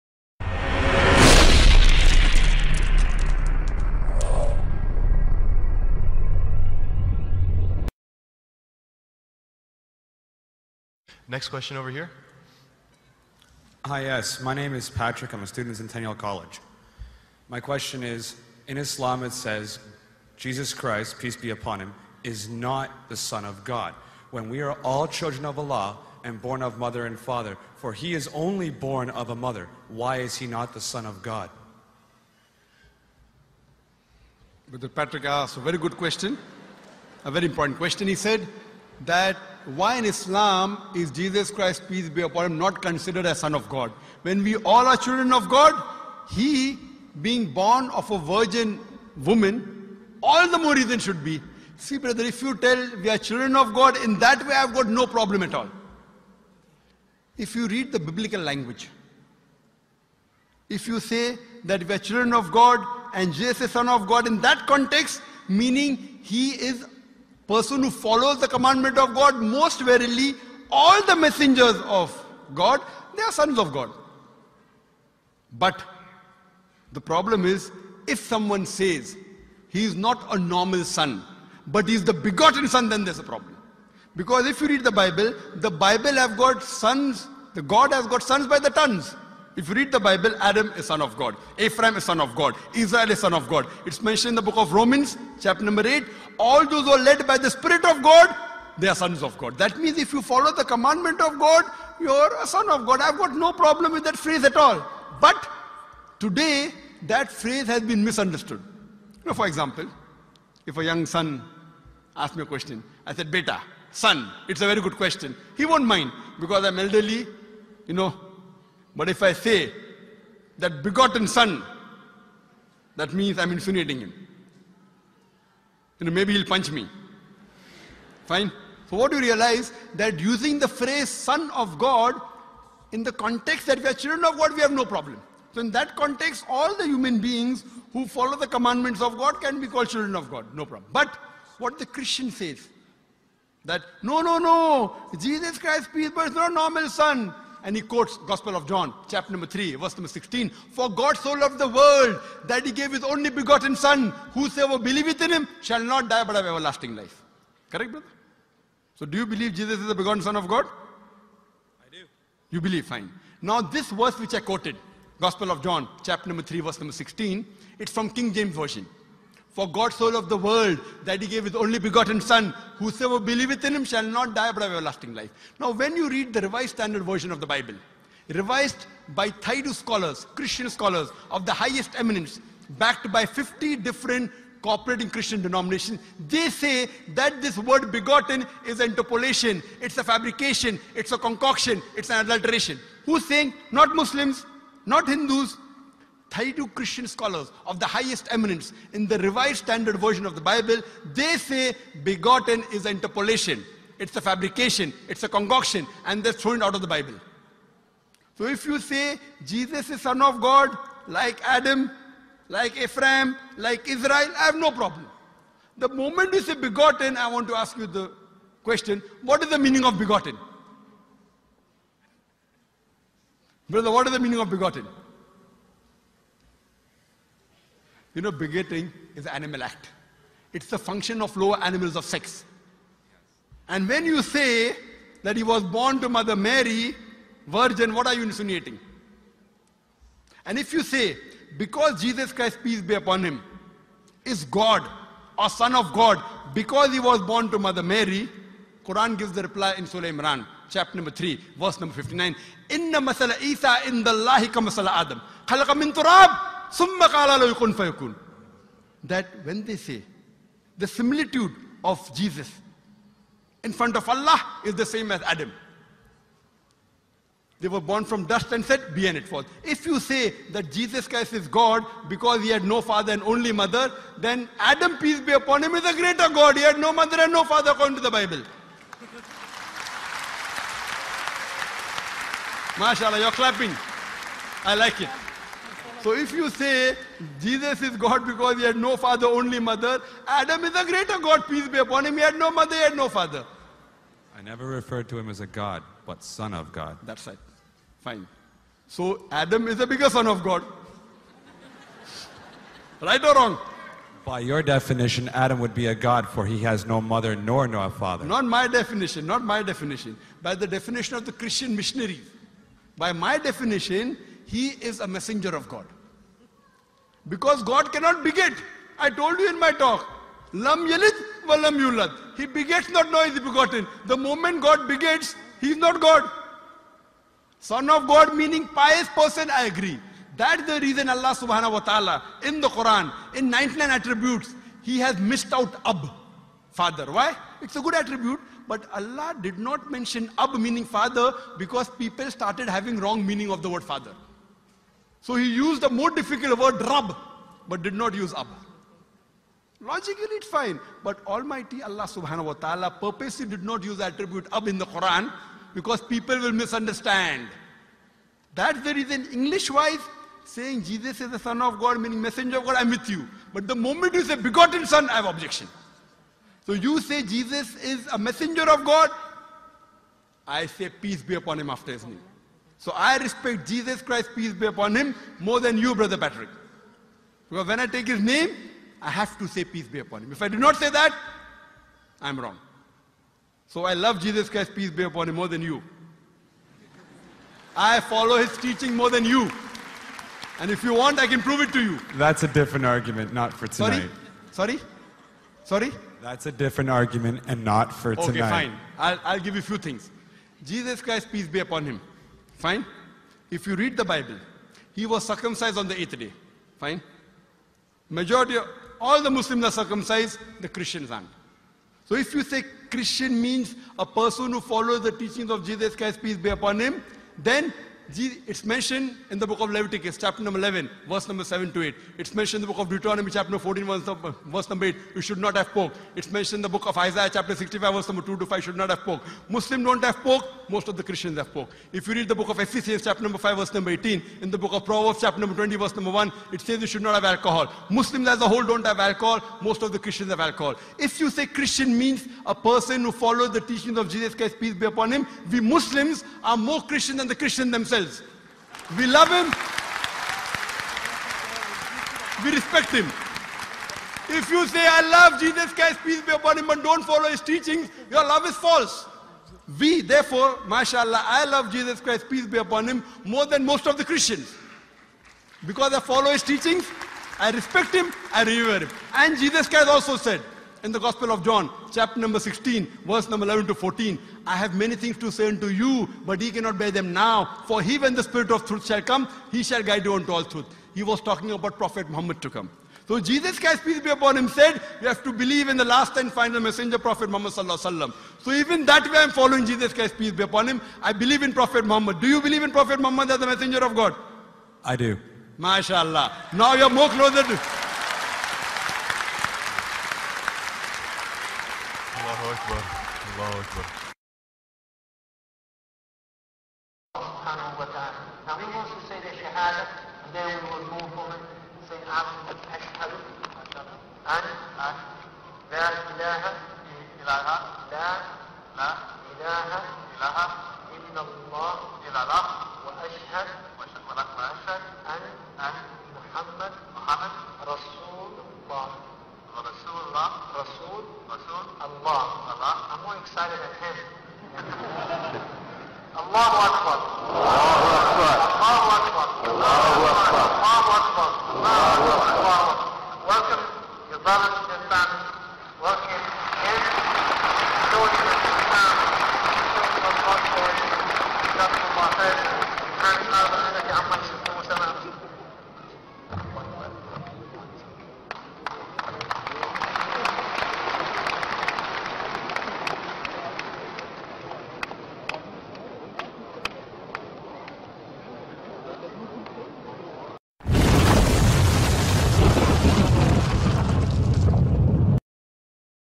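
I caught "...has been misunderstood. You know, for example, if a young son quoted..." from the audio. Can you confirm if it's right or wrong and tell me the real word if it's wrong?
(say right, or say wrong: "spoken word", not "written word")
wrong: "asked", not "quoted".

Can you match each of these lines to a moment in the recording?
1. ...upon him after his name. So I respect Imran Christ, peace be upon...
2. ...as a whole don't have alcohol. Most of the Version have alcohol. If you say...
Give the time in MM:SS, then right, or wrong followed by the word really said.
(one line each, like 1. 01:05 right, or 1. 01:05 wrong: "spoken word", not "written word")
1. 06:11 wrong: "Jesus", not "Imran"
2. 07:18 wrong: "Christians", not "Version".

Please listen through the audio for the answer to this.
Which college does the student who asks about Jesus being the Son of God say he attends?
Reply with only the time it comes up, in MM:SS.
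00:15.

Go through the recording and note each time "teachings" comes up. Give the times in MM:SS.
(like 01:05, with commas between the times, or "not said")
06:28, 06:55, 07:23, 07:37, 07:46.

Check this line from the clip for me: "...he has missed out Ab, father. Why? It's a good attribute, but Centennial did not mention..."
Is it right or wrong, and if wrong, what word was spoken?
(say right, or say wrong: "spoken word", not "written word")
wrong: "Allah", not "Centennial".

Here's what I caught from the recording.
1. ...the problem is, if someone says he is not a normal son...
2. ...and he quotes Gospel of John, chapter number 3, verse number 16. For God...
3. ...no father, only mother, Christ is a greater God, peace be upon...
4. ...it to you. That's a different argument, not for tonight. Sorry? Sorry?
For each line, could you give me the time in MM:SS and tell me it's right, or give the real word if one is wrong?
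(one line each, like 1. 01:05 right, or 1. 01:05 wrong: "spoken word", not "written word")
1. 01:16 right
2. 02:27 right
3. 04:48 wrong: "Adam", not "Christ"
4. 06:31 right.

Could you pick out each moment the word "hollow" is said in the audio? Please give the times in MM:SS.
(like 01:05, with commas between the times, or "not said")
not said.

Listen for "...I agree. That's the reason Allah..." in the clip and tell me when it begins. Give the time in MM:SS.
05:29.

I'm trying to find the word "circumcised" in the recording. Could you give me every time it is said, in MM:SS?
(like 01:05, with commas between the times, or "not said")
06:45, 06:49.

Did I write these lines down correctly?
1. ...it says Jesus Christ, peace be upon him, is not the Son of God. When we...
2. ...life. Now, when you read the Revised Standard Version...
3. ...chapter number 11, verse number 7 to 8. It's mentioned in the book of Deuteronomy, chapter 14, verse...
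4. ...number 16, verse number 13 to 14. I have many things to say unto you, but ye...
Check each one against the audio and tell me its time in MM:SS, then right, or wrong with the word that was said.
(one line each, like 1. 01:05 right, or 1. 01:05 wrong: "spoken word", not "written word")
1. 00:19 right
2. 02:55 right
3. 07:00 right
4. 07:52 wrong: "11", not "13".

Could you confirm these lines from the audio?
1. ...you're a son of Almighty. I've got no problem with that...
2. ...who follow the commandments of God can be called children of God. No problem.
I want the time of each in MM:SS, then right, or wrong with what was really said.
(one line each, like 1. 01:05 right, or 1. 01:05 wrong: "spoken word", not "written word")
1. 01:41 wrong: "God", not "Almighty"
2. 02:17 right.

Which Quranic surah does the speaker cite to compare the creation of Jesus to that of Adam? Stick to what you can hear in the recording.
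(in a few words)
Surah Imran.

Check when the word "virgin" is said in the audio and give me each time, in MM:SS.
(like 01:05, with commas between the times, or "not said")
00:48, 03:57.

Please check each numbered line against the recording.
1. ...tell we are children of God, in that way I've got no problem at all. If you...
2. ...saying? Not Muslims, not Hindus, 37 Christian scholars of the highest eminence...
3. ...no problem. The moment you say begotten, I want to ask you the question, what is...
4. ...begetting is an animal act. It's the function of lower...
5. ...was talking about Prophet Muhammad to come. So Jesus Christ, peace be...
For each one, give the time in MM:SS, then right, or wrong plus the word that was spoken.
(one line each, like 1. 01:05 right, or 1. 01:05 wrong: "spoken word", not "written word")
1. 00:52 right
2. 03:13 wrong: "32", not "37"
3. 03:34 right
4. 03:48 right
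5. 08:01 right.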